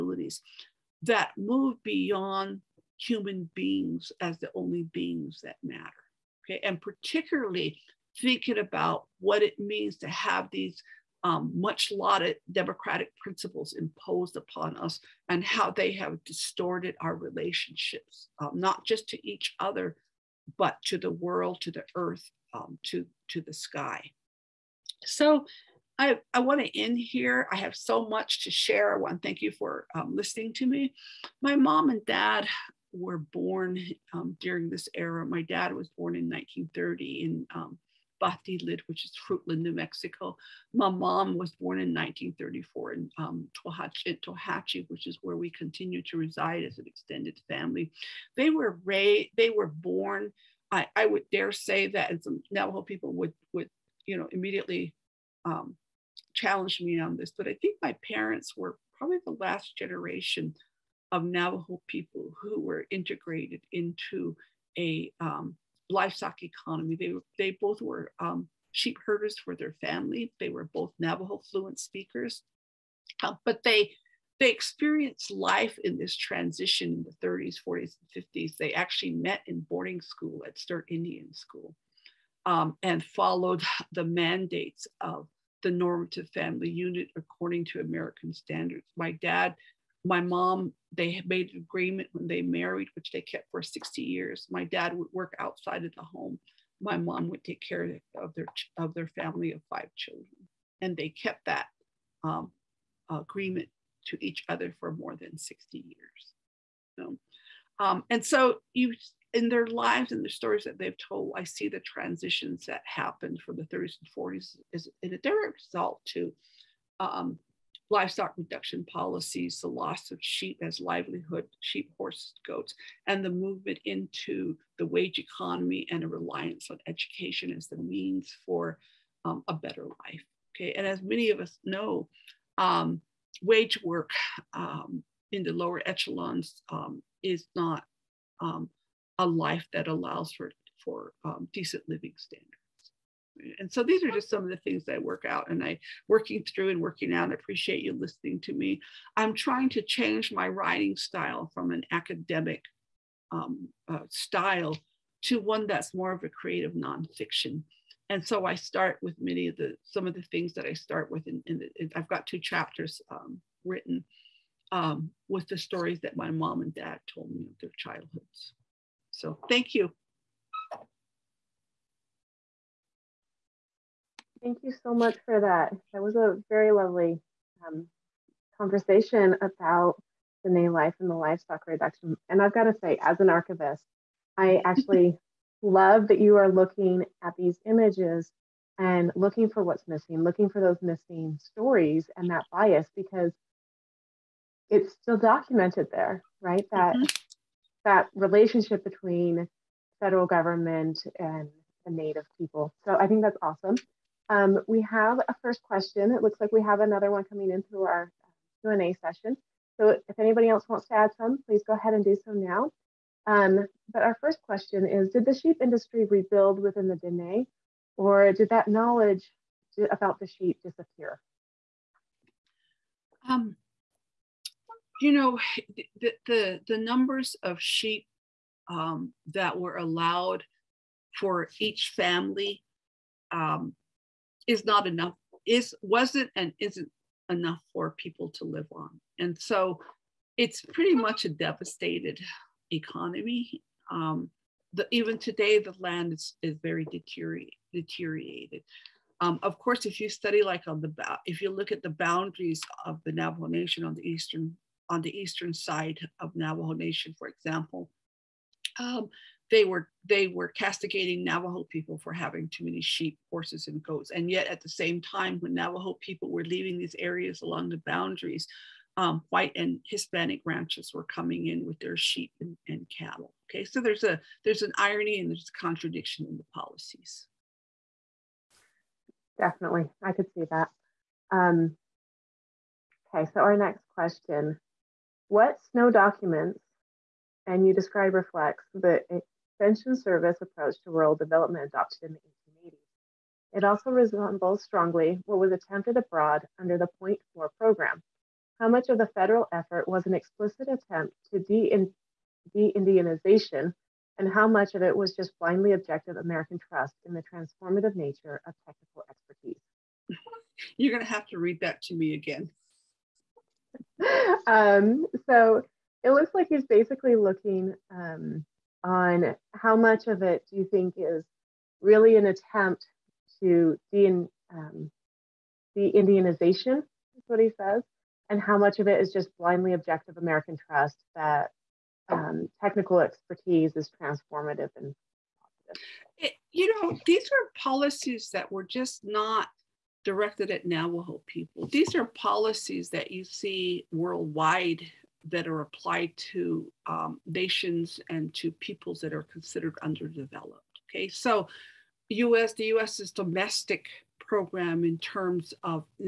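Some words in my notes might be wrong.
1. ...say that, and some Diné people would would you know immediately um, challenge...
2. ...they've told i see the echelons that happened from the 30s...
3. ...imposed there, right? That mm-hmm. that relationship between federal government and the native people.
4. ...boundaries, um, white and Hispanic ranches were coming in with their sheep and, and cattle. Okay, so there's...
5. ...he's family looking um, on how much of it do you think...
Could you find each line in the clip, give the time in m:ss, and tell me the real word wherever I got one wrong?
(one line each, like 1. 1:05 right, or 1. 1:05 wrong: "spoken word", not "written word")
1. 0:51 wrong: "Navajo", not "Diné"
2. 1:50 wrong: "transitions", not "echelons"
3. 3:15 wrong: "documented", not "imposed"
4. 4:27 right
5. 5:16 wrong: "basically", not "family".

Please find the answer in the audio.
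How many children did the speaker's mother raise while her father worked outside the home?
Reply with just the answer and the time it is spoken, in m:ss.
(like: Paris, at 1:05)
5, at 1:39.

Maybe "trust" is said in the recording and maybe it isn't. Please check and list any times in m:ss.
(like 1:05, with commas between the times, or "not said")
5:06, 5:30.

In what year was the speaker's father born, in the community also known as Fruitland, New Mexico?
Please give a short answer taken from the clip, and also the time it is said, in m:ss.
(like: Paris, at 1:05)
1930, at 0:36.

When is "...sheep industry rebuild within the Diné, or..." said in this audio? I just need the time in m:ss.
3:35.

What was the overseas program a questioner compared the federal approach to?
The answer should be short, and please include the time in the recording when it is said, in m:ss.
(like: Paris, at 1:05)
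Point 4 program, at 4:56.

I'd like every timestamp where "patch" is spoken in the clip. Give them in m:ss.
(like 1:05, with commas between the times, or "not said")
not said.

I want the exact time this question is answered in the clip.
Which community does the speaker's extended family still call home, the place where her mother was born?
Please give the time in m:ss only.
0:43.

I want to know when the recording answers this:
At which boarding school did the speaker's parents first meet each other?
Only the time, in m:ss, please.
1:20.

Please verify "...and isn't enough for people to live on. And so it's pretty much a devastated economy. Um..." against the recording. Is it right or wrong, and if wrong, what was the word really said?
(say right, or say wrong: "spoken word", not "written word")
right.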